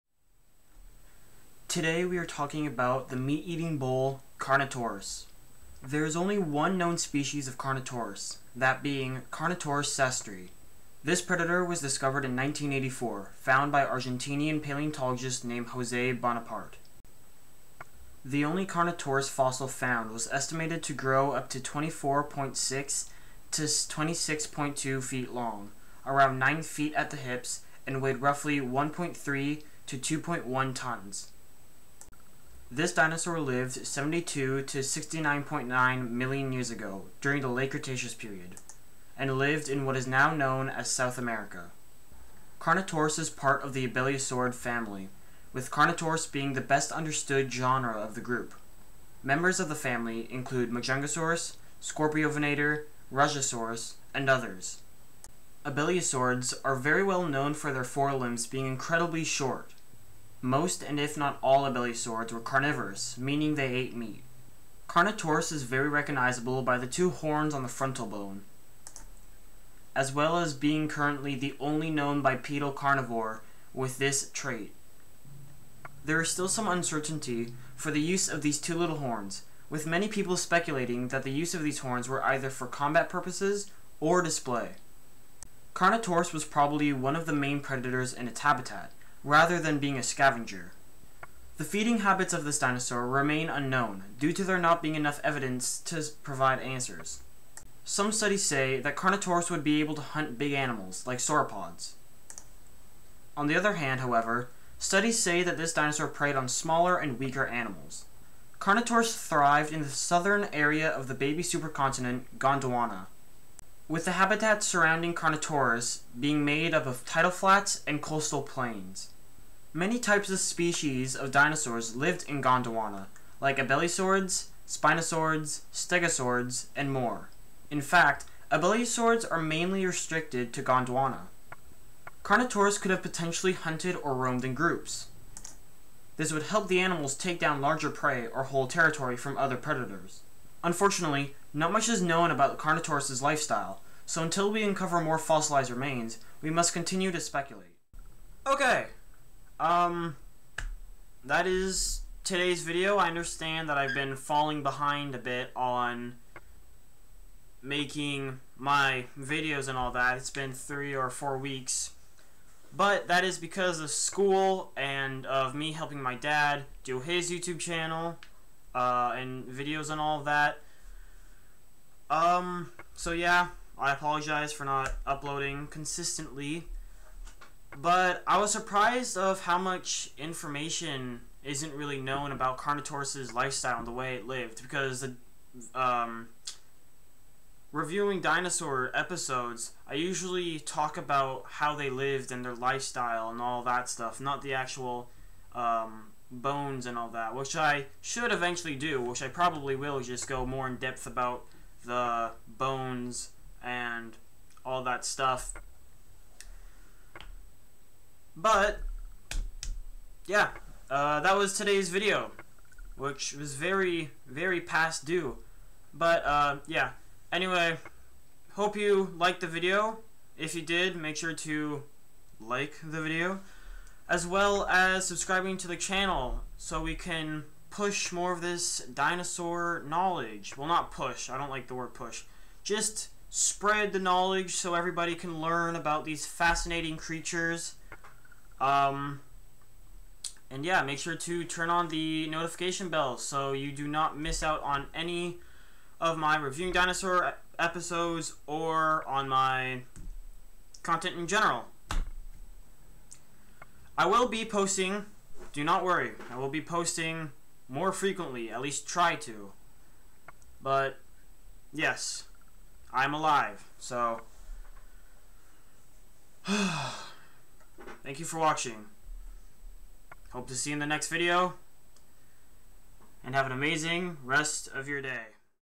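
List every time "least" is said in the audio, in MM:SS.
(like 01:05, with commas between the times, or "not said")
04:18.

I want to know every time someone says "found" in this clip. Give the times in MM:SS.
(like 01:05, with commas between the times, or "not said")
00:13, 00:19.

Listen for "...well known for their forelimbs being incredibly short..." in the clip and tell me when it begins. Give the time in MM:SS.
00:57.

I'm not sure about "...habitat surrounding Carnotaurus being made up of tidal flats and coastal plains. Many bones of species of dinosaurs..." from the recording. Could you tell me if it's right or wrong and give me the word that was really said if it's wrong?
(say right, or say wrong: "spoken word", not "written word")
wrong: "types", not "bones".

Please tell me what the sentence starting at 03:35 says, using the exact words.
But, uh, yeah, anyway, hope you liked the video.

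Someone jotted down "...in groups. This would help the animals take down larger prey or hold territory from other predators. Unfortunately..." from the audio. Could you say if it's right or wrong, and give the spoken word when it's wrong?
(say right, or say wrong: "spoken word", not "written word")
right.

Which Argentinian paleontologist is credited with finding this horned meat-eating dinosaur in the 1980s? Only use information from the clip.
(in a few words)
Jose Bonaparte.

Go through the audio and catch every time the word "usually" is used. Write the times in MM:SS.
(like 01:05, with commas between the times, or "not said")
03:09.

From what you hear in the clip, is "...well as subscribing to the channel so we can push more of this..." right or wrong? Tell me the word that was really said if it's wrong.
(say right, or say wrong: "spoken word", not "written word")
right.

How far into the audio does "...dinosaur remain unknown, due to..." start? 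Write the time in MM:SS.
01:32.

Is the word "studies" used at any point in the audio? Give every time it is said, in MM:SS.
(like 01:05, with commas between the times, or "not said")
01:38, 01:44.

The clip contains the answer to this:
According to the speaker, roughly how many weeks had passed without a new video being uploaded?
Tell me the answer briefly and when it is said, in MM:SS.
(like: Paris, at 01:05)
3 or 4 weeks, at 02:40.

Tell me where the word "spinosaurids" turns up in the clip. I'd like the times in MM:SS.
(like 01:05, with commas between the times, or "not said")
02:04.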